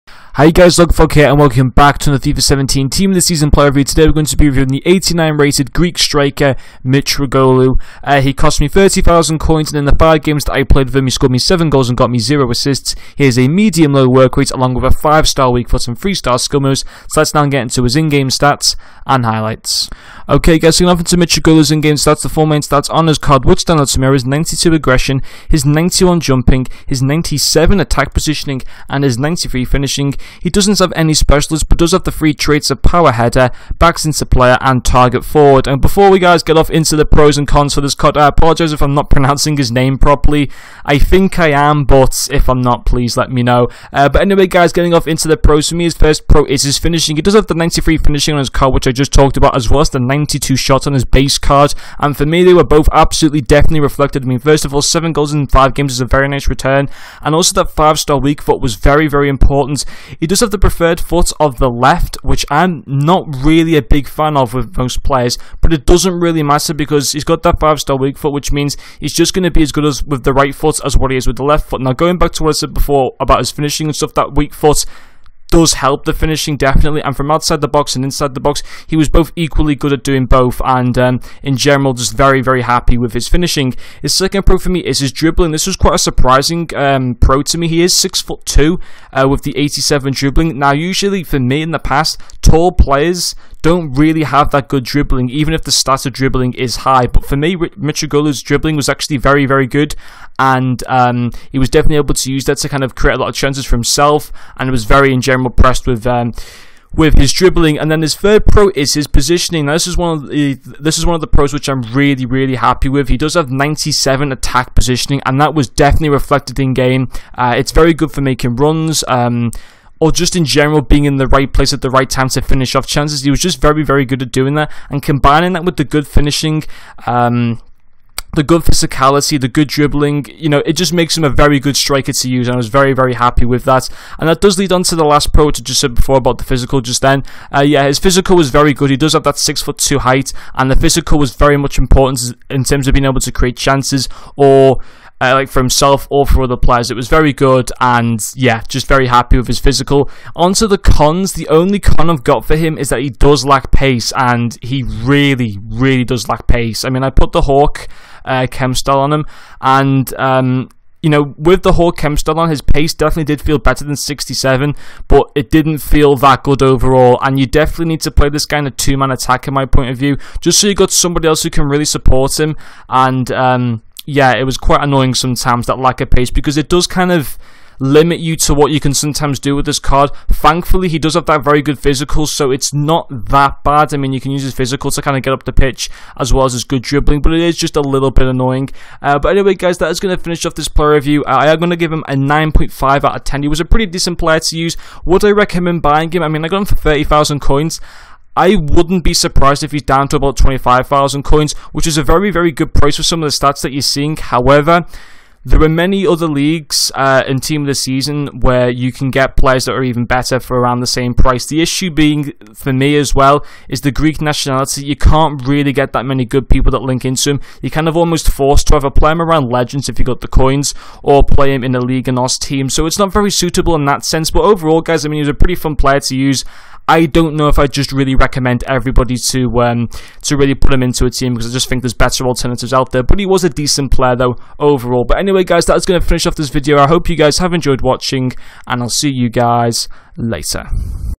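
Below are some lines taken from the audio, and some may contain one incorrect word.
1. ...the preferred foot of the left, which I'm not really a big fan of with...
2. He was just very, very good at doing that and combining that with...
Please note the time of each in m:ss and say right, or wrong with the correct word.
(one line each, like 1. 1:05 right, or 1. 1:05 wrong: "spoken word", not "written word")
1. 1:00 right
2. 2:03 right.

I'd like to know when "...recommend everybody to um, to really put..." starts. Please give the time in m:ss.
3:48.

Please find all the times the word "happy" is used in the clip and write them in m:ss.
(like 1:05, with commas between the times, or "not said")
1:22, 1:52, 2:13, 2:29.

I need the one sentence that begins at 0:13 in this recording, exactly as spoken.
He has a medium low work rate along with a 5 star weak foot and 3 star skill moves.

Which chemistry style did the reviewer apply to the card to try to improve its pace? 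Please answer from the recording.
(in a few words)
Hawk.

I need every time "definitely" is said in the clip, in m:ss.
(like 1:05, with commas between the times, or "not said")
0:53, 1:16, 1:41, 1:55, 2:42, 2:47.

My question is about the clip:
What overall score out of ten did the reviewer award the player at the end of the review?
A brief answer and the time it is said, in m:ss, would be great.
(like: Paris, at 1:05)
9.5, at 3:12.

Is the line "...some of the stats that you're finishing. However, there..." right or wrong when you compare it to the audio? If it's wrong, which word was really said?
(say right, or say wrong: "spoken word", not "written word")
wrong: "seeing", not "finishing".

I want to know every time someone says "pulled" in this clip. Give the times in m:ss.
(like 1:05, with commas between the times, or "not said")
not said.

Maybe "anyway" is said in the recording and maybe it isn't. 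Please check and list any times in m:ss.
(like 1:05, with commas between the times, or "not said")
0:44, 3:09, 3:55.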